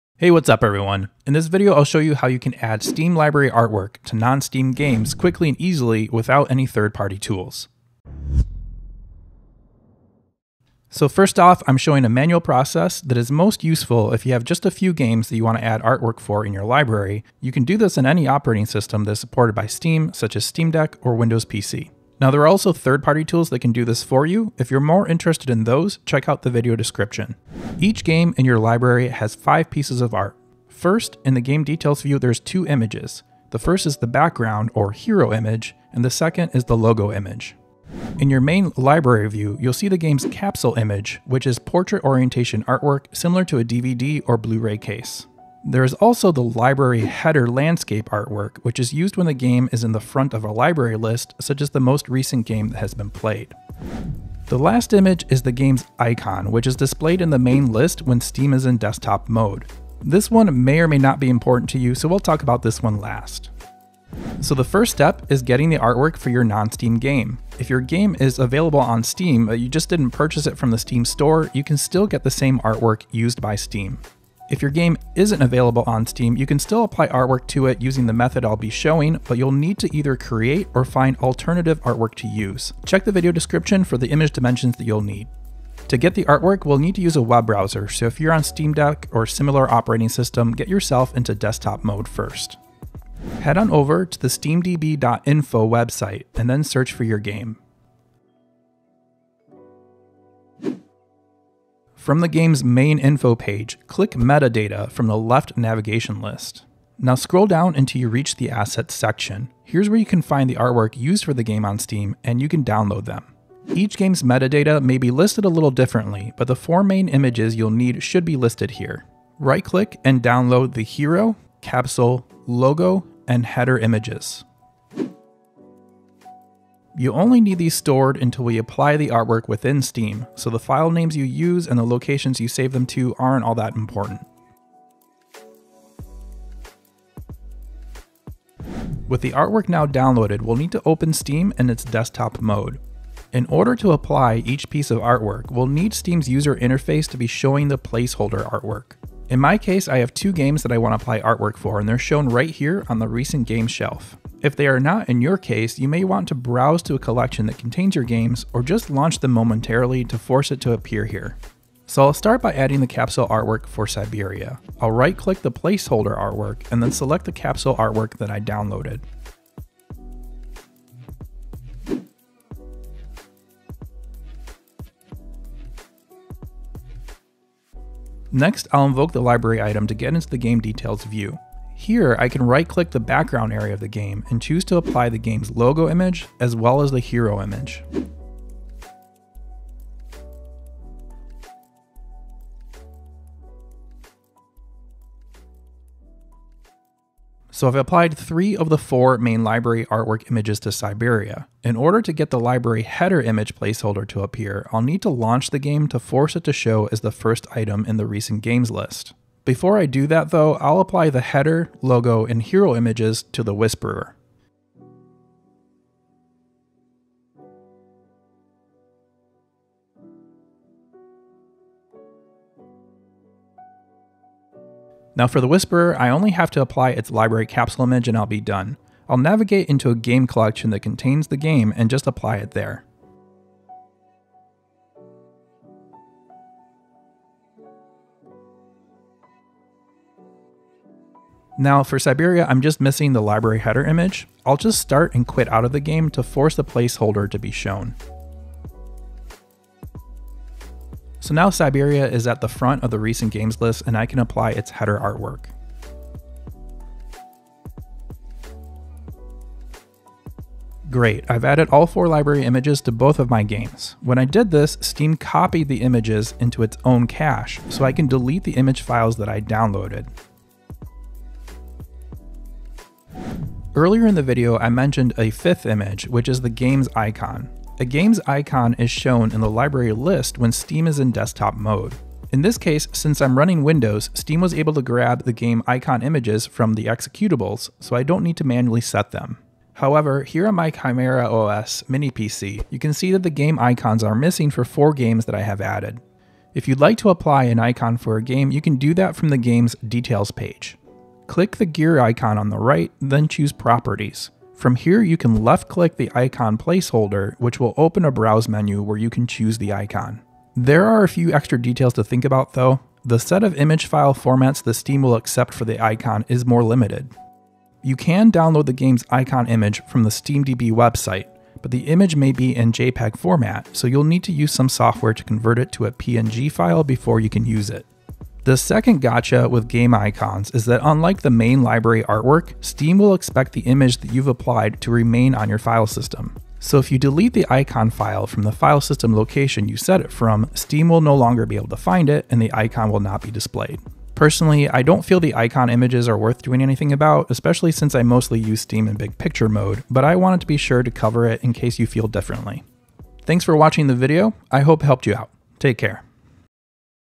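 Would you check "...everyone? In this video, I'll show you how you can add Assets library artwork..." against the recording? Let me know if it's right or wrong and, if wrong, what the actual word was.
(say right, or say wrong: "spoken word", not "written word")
wrong: "Steam", not "Assets".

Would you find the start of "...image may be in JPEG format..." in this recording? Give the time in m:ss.
5:21.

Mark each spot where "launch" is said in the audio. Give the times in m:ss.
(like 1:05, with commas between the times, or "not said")
2:38, 3:25.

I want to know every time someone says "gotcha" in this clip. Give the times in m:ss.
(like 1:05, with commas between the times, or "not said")
5:29.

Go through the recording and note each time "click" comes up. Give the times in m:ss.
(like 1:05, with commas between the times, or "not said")
1:43, 1:59, 2:45, 3:02, 5:01, 5:05.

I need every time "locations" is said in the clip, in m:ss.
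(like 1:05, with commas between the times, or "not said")
2:11, 5:39.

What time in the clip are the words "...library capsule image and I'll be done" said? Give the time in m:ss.
3:47.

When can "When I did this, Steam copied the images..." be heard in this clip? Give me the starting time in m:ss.
4:24.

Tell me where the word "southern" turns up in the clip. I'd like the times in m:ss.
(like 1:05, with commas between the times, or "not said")
not said.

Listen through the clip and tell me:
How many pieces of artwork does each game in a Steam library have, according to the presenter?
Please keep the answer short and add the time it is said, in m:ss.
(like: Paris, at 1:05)
5, at 0:29.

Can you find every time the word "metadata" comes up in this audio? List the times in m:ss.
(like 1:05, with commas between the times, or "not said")
1:44, 1:54.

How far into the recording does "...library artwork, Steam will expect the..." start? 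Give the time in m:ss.
5:31.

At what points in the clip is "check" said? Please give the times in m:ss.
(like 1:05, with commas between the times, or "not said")
0:26, 1:22.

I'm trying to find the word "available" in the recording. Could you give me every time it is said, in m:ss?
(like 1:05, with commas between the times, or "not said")
1:08, 1:15.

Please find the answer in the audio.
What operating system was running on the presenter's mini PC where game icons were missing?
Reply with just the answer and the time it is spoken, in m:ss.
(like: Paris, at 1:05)
Chimera OS, at 4:50.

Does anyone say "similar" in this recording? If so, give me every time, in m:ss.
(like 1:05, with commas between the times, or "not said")
0:43, 1:29.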